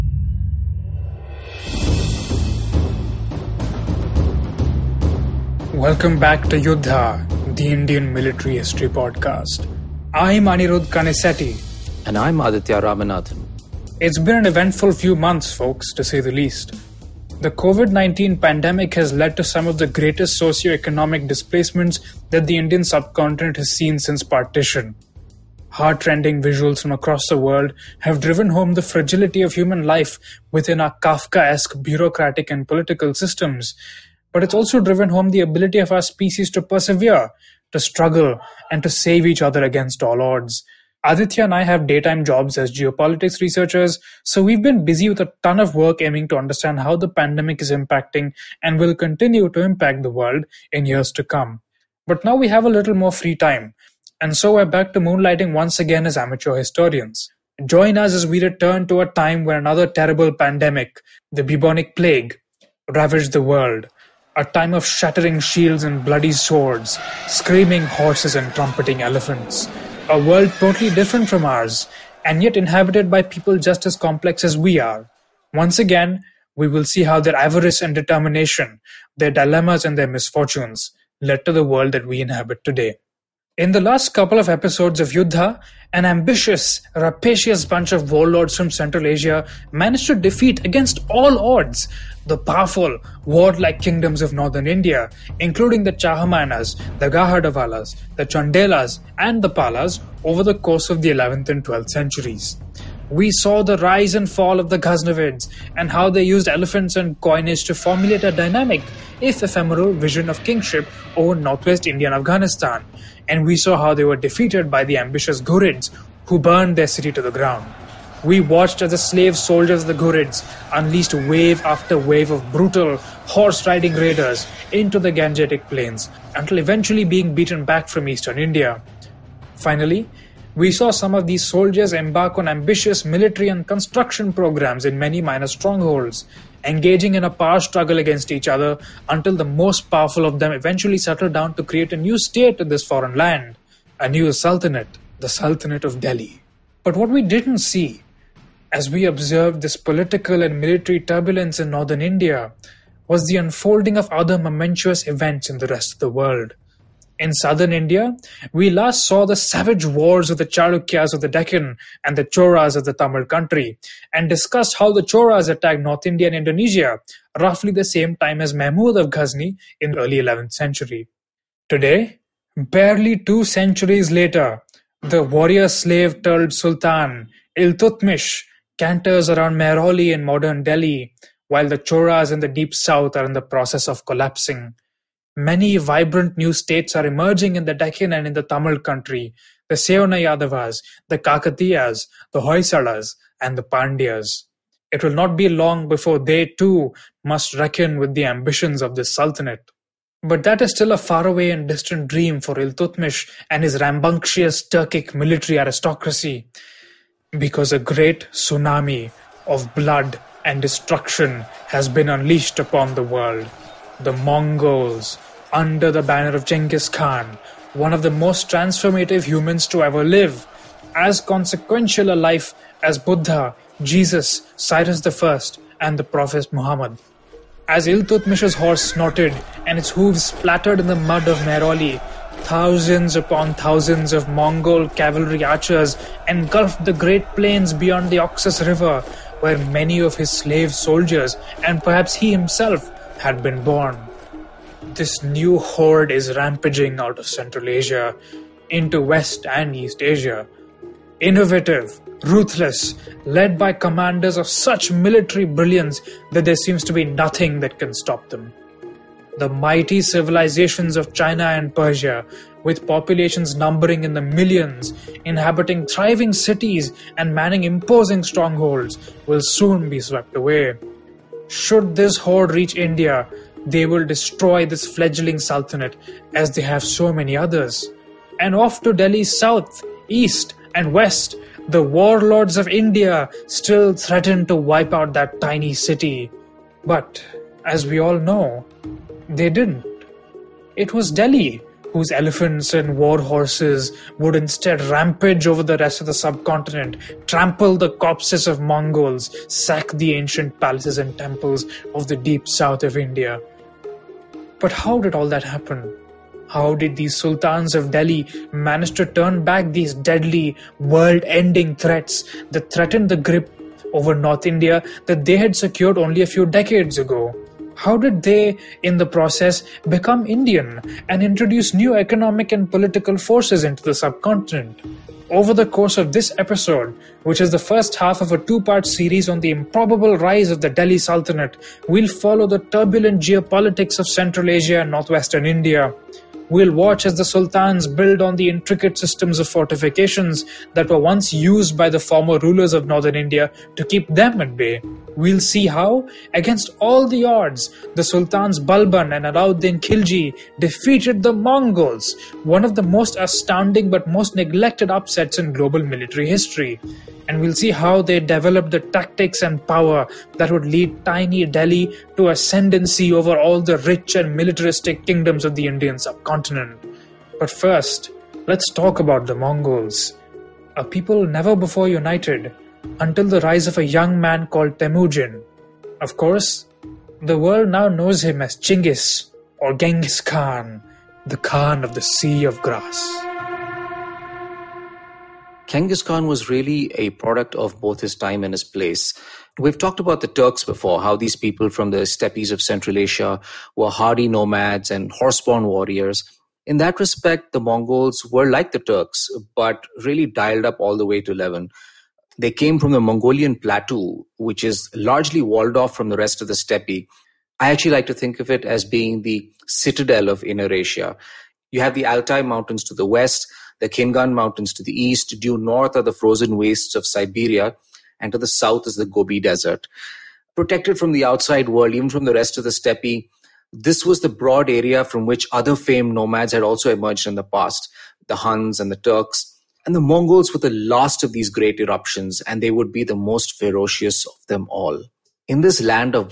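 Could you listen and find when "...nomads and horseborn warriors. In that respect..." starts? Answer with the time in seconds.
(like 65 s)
394 s.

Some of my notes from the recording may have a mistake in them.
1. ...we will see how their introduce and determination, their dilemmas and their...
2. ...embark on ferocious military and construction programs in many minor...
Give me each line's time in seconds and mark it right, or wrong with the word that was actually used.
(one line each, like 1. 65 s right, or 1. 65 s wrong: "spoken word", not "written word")
1. 76 s wrong: "avarice", not "introduce"
2. 131 s wrong: "ambitious", not "ferocious".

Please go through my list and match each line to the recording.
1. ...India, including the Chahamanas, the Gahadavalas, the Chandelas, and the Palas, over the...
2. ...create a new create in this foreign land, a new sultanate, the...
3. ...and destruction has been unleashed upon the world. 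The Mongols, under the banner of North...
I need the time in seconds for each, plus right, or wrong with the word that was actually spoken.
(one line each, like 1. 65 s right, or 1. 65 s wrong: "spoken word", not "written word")
1. 94 s right
2. 141 s wrong: "state", not "create"
3. 210 s wrong: "Genghis", not "North".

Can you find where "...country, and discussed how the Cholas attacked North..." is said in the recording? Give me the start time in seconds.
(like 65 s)
163 s.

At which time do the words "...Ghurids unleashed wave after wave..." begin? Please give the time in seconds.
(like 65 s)
120 s.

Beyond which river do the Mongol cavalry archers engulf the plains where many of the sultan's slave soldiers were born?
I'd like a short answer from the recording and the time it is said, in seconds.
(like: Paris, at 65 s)
Oxus River, at 238 s.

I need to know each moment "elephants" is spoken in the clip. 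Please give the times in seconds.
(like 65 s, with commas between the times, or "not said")
69 s, 106 s, 292 s.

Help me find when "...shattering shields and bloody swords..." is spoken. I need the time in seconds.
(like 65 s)
64 s.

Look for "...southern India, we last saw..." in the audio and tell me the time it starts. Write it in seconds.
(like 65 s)
157 s.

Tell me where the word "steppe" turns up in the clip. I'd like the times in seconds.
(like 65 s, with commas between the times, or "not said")
392 s, 406 s, 422 s.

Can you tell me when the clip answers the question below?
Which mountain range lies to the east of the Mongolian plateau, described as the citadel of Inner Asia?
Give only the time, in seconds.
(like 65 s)
413 s.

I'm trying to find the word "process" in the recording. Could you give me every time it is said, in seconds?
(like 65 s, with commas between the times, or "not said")
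183 s, 319 s.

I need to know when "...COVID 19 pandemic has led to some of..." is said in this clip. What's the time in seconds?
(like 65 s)
17 s.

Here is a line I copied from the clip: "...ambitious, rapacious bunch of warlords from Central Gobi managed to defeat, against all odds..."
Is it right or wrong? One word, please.
wrong.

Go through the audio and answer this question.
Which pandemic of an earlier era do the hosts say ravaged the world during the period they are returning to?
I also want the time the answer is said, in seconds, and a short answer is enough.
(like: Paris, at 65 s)
bubonic plague, at 61 s.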